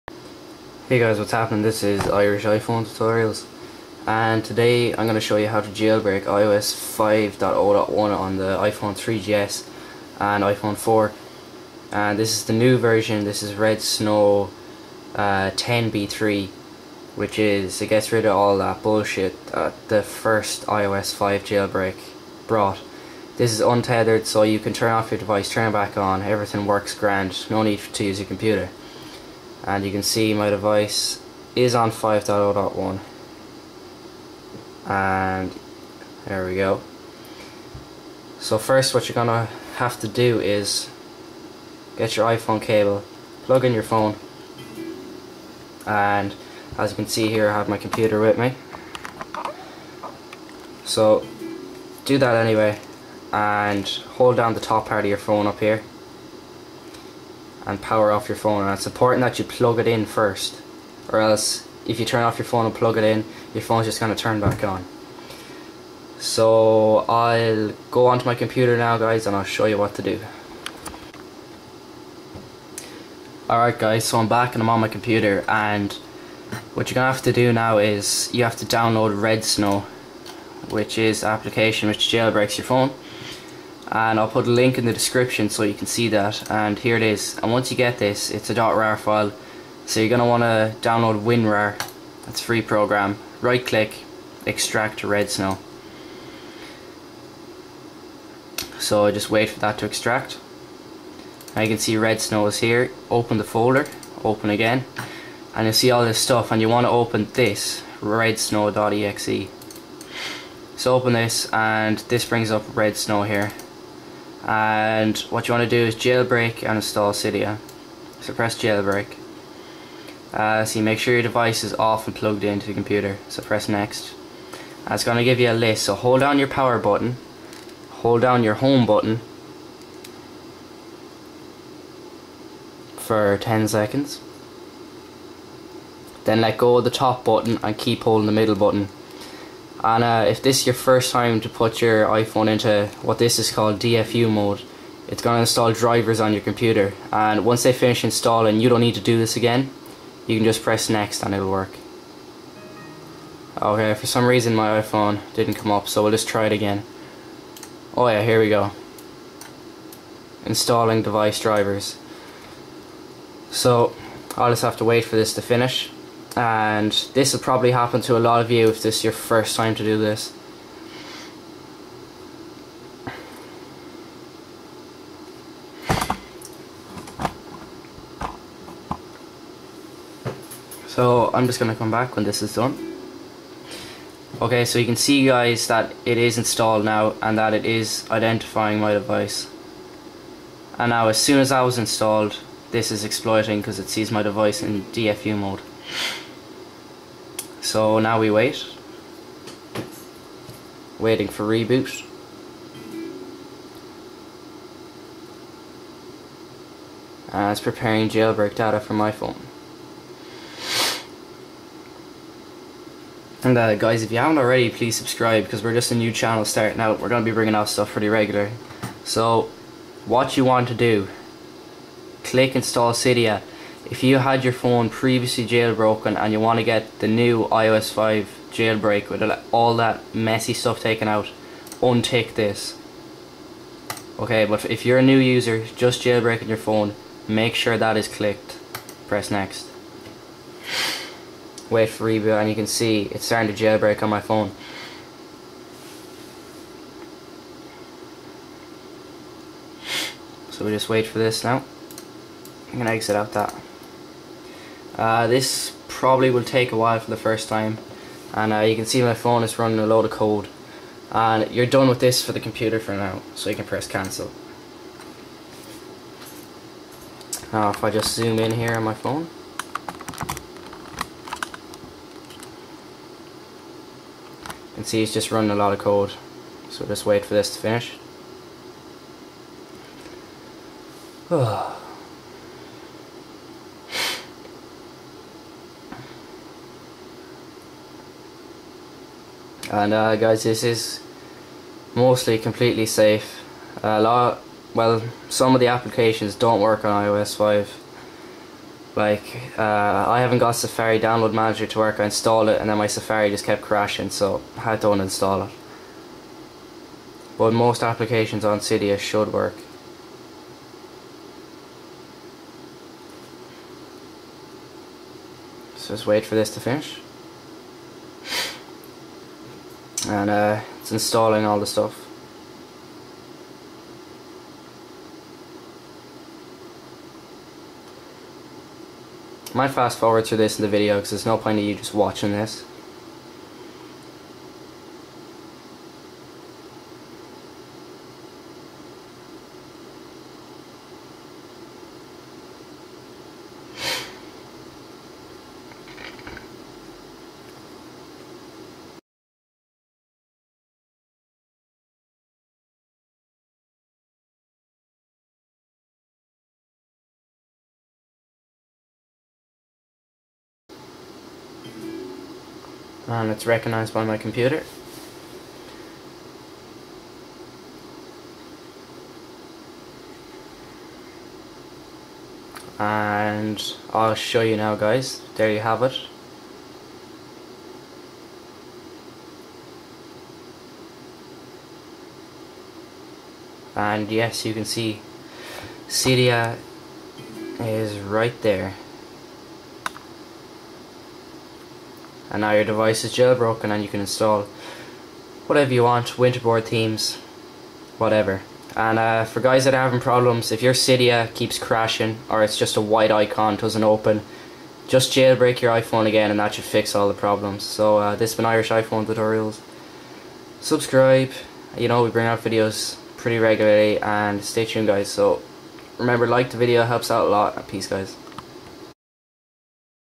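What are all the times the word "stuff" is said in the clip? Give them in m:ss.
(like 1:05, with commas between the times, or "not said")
1:46, 3:37, 3:50, 5:21.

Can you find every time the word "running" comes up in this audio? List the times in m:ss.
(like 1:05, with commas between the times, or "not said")
4:19, 4:35.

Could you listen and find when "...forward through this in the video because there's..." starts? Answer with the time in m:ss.
5:29.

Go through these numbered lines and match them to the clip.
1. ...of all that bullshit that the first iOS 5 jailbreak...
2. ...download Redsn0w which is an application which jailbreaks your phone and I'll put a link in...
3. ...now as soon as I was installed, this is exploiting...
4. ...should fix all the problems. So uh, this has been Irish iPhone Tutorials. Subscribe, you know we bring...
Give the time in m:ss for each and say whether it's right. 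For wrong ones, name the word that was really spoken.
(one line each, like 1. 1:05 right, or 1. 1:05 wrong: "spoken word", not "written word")
1. 0:18 right
2. 1:18 right
3. 3:10 right
4. 6:46 right.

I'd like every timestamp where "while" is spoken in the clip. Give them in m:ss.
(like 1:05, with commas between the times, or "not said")
4:16.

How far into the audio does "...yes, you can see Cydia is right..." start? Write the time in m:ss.
6:24.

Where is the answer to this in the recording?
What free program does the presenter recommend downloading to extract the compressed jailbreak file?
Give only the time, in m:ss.
1:31.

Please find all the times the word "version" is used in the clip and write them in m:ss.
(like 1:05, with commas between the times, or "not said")
0:12.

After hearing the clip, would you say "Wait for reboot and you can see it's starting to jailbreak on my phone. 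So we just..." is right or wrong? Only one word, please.
right.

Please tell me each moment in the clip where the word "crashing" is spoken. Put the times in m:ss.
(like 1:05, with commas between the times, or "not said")
5:03, 6:41.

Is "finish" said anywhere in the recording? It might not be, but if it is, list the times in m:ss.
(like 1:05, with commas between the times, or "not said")
2:27, 2:45, 4:37, 5:16.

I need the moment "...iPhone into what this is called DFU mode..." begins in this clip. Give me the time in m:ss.
2:22.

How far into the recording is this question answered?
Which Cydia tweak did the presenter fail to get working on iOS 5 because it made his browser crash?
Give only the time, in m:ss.
5:00.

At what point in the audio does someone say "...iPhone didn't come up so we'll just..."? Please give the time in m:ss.
2:34.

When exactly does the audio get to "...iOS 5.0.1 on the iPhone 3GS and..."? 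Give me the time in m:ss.
0:06.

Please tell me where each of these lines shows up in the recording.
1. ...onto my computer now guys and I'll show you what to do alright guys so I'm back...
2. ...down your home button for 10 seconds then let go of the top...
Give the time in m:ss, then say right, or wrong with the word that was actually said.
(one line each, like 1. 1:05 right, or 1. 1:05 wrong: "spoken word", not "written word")
1. 1:08 right
2. 2:08 right.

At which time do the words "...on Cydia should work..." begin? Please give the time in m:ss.
5:08.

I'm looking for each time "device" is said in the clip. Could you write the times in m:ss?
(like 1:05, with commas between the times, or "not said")
0:25, 0:30, 2:01, 2:41, 3:08, 3:14, 6:32.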